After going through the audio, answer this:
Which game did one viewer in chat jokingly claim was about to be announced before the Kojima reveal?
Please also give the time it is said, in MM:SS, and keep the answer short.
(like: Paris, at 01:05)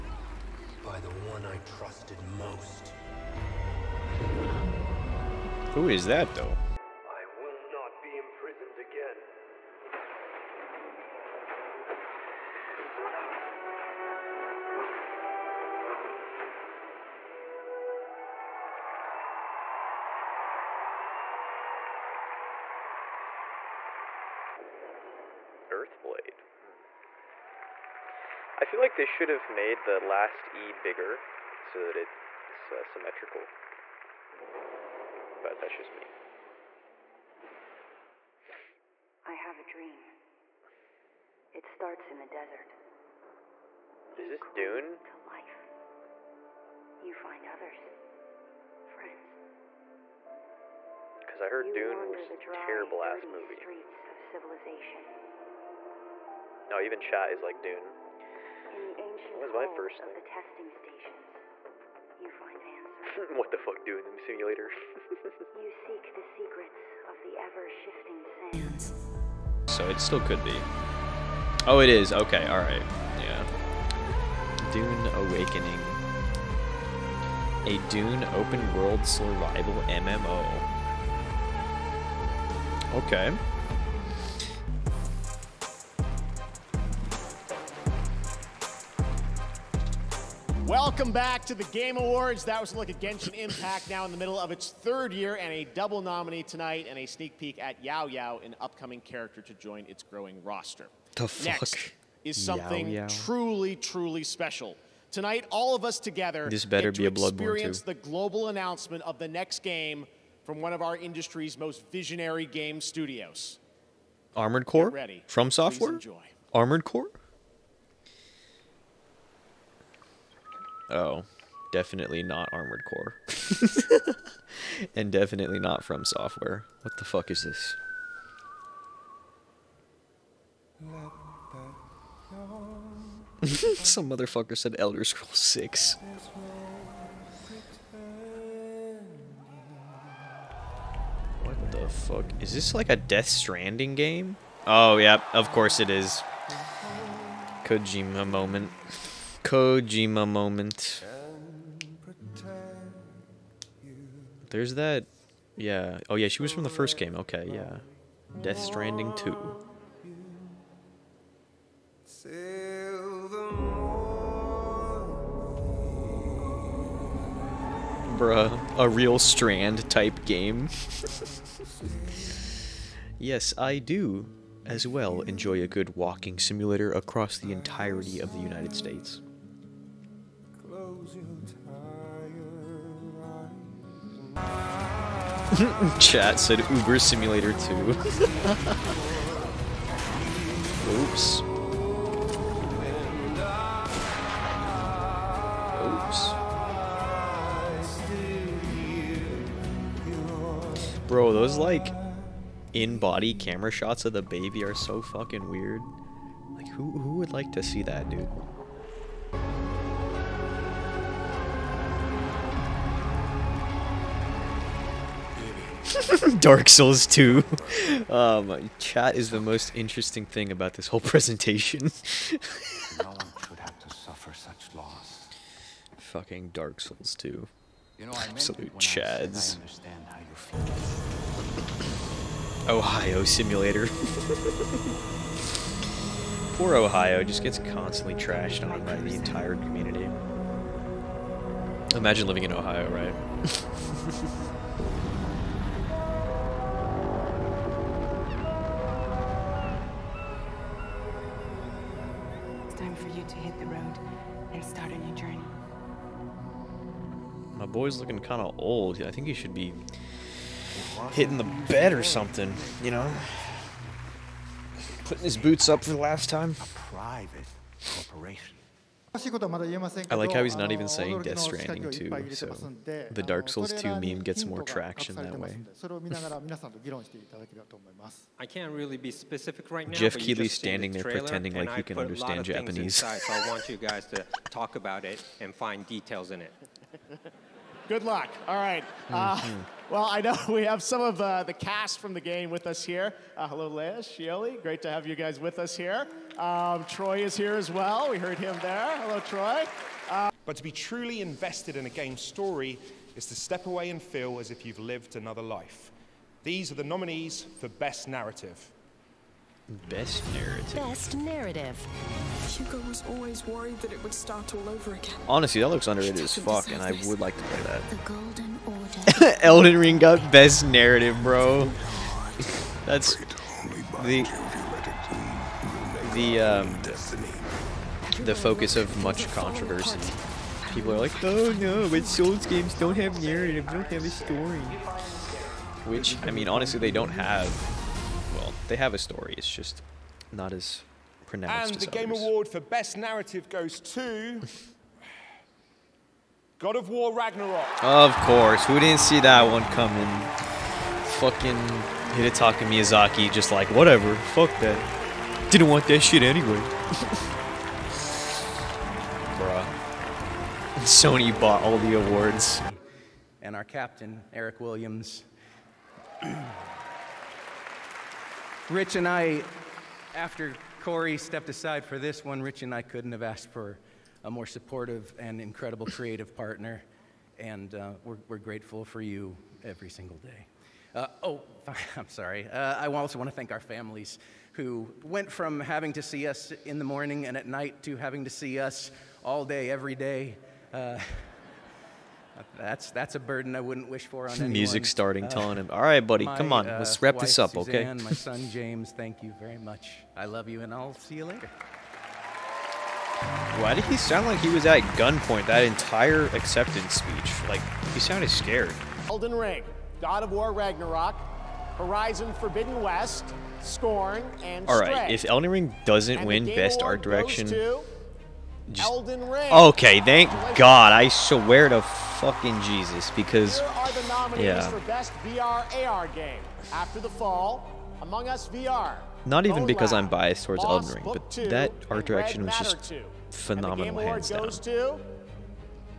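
Elder Scrolls 6, at 02:14.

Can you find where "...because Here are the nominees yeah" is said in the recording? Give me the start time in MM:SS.
07:03.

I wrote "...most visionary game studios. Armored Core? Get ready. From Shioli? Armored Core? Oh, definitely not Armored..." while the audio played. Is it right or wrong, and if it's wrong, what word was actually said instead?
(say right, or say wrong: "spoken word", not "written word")
wrong: "Software", not "Shioli".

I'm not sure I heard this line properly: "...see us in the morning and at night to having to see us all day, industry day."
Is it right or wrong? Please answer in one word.
wrong.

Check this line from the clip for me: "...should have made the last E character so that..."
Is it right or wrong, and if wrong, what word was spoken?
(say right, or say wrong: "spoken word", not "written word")
wrong: "bigger", not "character".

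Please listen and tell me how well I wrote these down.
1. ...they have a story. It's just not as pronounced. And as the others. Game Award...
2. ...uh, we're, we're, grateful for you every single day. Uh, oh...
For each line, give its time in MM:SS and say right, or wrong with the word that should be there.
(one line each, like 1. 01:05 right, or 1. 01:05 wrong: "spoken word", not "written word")
1. 05:38 right
2. 06:17 right.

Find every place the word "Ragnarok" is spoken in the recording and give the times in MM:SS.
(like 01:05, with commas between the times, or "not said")
05:47, 06:50.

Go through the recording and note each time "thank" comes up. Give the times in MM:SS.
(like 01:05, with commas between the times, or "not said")
06:23, 06:38, 07:00.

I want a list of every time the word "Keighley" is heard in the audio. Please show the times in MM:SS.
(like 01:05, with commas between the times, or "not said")
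04:40.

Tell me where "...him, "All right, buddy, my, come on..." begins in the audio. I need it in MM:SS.
06:35.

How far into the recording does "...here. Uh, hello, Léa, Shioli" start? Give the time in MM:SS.
04:52.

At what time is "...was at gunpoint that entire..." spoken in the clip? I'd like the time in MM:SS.
06:44.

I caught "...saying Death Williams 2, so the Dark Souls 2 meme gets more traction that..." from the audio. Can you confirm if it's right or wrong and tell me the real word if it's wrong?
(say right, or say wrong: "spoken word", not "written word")
wrong: "Stranding", not "Williams".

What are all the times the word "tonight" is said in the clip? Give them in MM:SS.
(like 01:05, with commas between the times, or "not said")
01:36, 01:45.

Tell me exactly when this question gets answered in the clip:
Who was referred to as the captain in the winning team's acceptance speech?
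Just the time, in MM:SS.
06:04.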